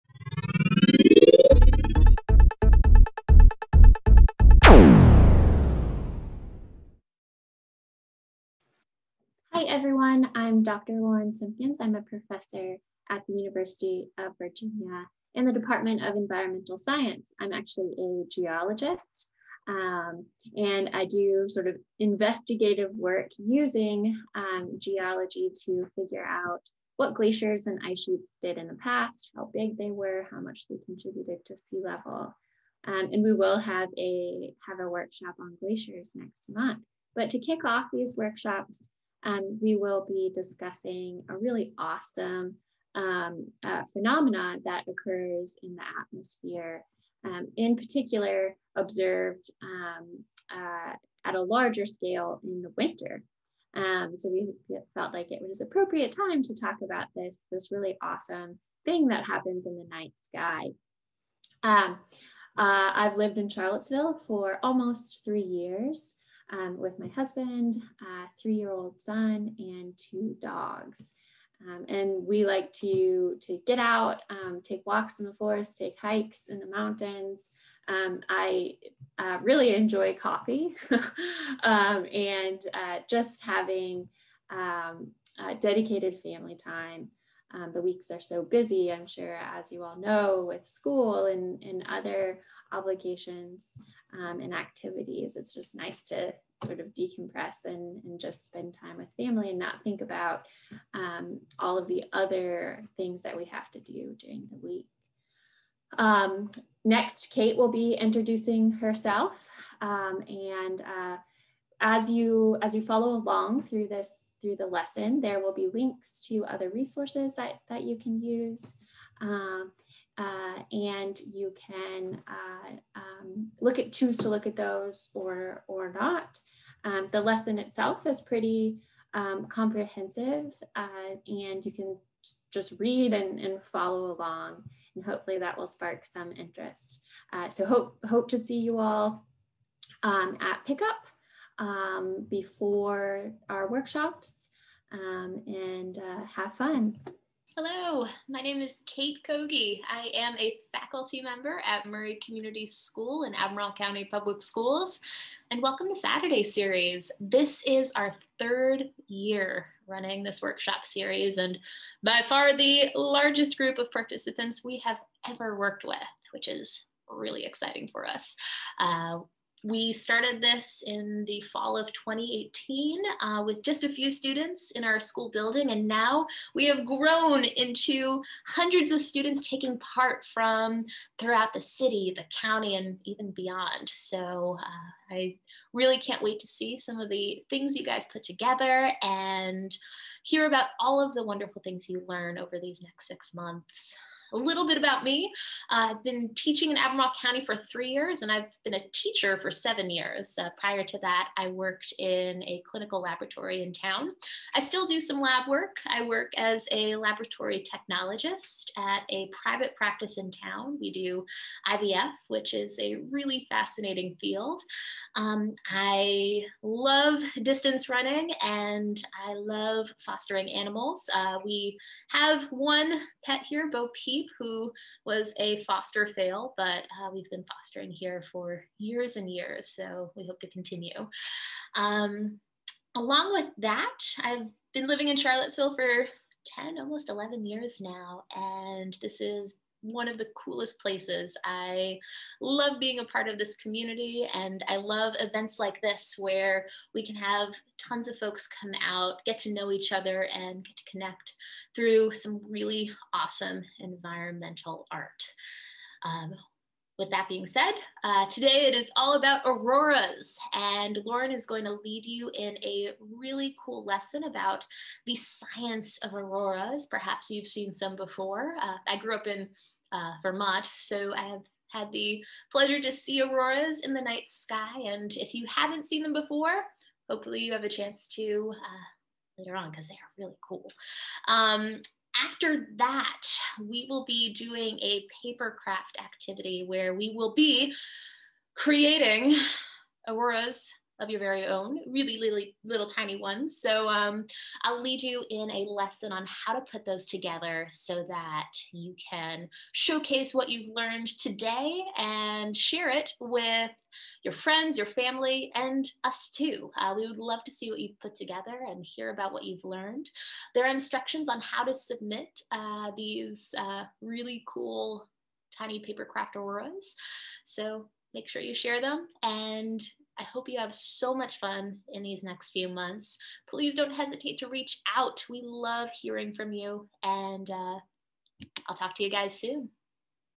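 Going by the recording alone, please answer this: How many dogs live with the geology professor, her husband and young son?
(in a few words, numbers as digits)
2.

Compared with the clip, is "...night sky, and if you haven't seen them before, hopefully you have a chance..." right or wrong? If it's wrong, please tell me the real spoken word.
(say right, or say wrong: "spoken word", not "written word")
right.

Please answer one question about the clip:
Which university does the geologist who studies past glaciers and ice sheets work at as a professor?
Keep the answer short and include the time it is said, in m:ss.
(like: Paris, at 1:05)
University of Virginia, at 0:13.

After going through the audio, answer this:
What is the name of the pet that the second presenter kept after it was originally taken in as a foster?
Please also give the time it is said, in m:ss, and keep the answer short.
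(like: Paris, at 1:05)
Bo Peep, at 3:43.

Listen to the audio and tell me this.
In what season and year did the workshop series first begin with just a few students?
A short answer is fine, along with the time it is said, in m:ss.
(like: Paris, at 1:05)
fall of 2018, at 2:51.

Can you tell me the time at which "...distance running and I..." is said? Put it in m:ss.
3:37.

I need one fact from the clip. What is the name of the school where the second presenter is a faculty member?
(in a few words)
Murray Community School.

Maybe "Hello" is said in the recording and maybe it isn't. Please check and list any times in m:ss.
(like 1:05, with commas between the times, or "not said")
2:27.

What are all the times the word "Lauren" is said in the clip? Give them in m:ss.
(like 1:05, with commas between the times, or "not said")
0:10, 4:21.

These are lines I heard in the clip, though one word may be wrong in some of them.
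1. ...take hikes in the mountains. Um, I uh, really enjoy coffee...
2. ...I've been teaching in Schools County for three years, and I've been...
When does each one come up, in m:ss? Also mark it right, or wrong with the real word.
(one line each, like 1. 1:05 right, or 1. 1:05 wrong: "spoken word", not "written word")
1. 1:15 right
2. 3:15 wrong: "Albemarle", not "Schools".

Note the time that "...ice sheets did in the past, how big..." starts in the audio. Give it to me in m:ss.
0:27.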